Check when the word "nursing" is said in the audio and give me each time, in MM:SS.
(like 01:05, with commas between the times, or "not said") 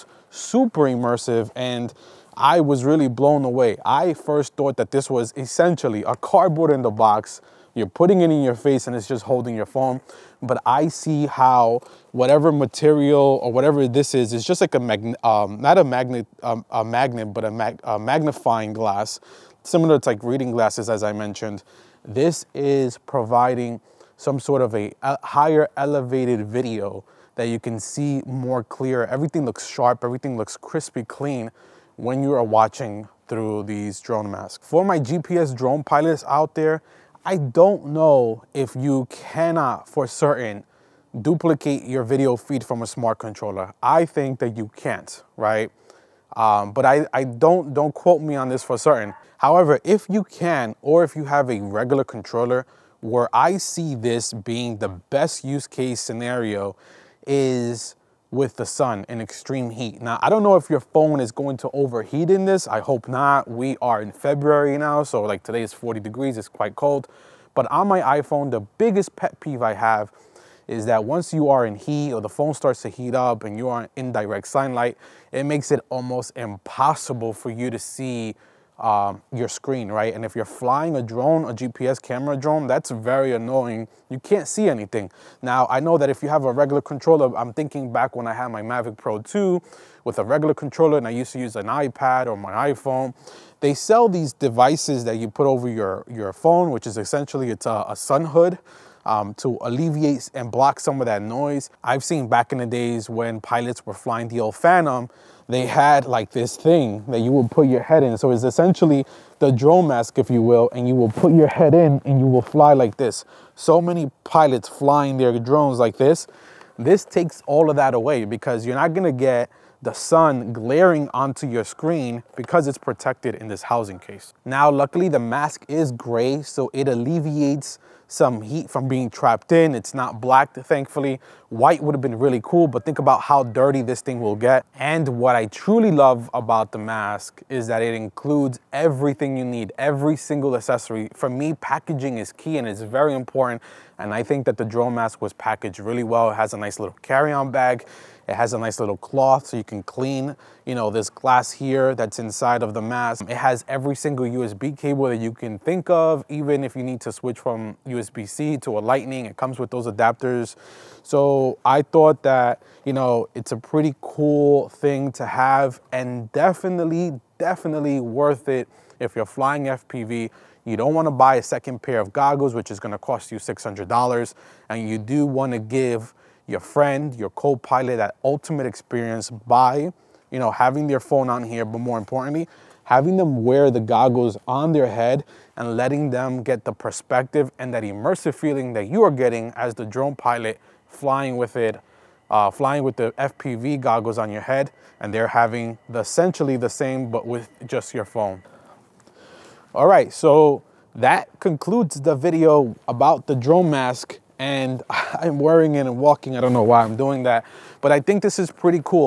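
not said.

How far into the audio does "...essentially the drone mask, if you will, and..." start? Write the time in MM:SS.
01:48.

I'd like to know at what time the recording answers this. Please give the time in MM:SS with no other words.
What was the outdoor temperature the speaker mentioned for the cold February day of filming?
01:05.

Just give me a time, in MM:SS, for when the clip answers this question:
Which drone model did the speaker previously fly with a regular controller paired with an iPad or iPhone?
01:28.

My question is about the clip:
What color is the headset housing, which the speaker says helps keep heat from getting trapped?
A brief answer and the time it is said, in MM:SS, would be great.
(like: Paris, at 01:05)
Gray, at 02:05.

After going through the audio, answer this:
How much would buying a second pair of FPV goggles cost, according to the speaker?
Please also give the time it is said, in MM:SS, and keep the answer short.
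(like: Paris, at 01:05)
$600, at 02:53.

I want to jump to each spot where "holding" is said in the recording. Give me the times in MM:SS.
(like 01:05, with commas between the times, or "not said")
00:09.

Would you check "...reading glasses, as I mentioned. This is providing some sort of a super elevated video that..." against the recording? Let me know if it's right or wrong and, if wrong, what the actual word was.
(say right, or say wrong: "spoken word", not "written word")
wrong: "higher", not "super".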